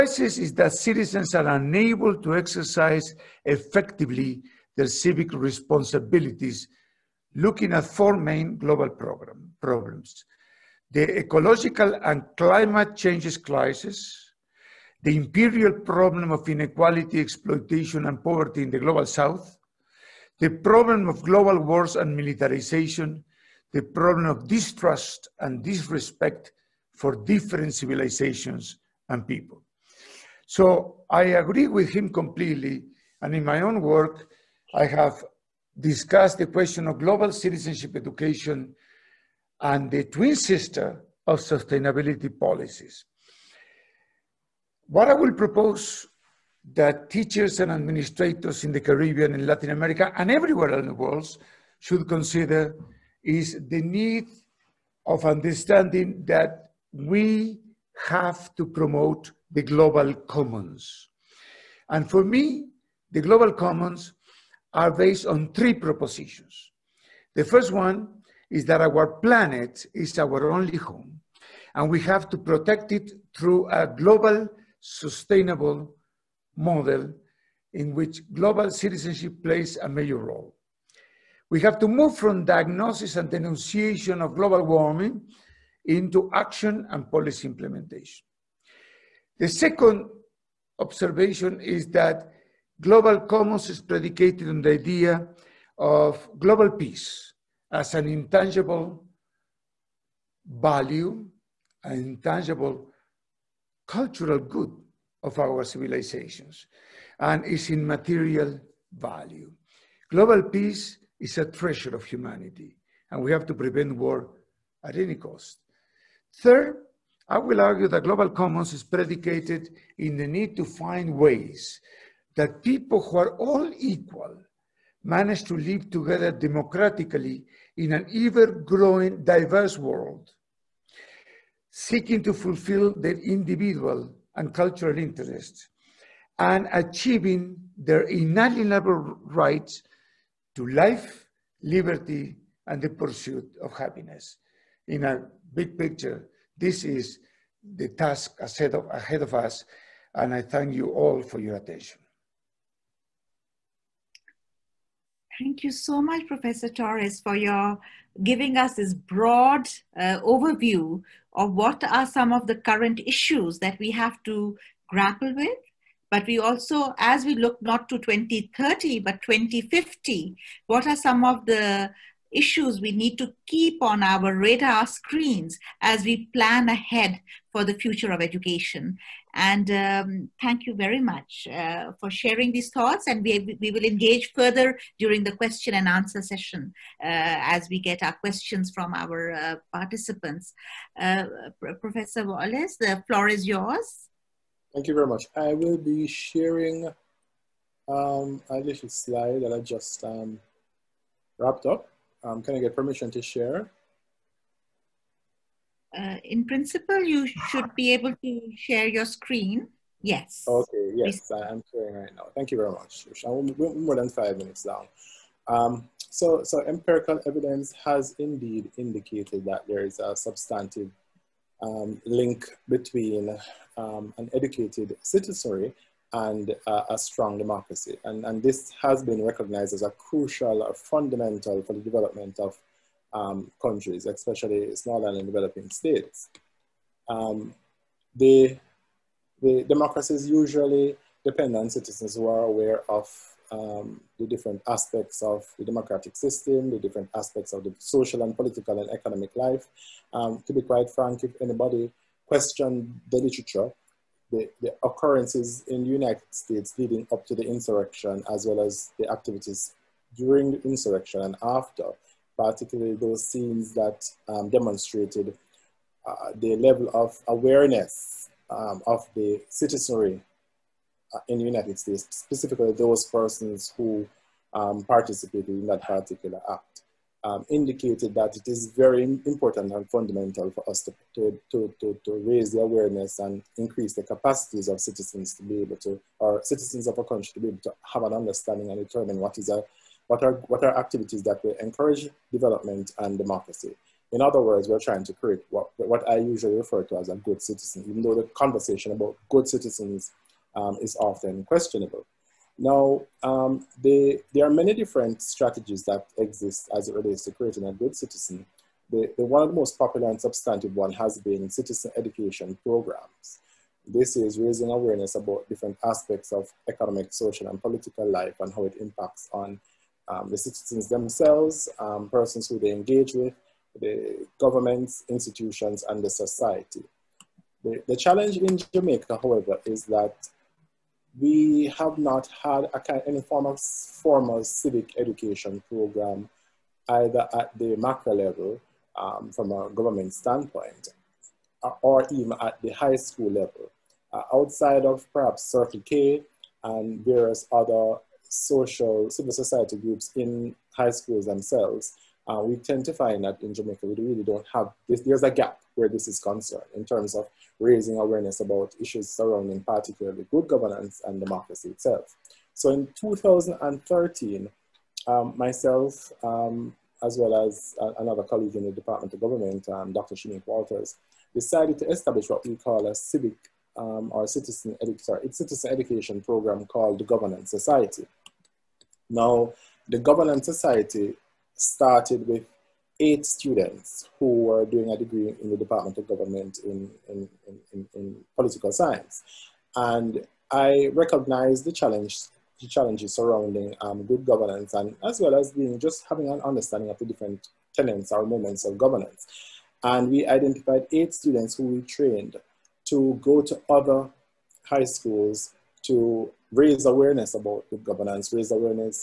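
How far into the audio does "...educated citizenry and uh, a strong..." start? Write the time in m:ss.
3:44.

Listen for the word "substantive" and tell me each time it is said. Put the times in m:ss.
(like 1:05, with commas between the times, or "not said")
3:40, 5:10.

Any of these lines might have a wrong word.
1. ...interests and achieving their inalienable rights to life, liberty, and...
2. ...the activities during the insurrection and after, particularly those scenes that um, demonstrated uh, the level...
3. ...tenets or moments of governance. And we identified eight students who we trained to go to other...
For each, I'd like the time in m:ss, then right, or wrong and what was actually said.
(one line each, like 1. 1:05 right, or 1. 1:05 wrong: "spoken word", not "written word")
1. 2:14 right
2. 4:18 right
3. 6:37 right.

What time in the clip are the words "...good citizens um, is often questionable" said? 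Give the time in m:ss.
4:59.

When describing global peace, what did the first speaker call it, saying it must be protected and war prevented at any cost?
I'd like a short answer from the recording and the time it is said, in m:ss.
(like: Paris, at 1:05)
A treasure of humanity, at 1:51.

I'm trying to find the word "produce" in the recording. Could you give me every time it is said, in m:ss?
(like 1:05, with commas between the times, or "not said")
not said.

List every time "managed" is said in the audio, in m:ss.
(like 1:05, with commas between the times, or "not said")
2:05.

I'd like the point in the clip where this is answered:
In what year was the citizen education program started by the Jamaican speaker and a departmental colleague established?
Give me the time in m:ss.
6:02.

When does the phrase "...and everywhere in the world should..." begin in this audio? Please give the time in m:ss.
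0:50.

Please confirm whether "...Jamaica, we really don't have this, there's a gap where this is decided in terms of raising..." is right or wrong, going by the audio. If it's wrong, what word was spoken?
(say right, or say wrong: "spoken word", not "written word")
wrong: "concerned", not "decided".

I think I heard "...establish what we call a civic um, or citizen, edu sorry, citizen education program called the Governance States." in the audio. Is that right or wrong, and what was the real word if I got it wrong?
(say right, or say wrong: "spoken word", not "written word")
wrong: "Society", not "States".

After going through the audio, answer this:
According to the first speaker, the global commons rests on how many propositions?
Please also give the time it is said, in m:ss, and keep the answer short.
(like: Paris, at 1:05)
3, at 1:05.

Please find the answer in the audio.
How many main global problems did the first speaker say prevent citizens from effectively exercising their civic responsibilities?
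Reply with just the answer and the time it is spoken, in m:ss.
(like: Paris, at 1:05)
4, at 0:07.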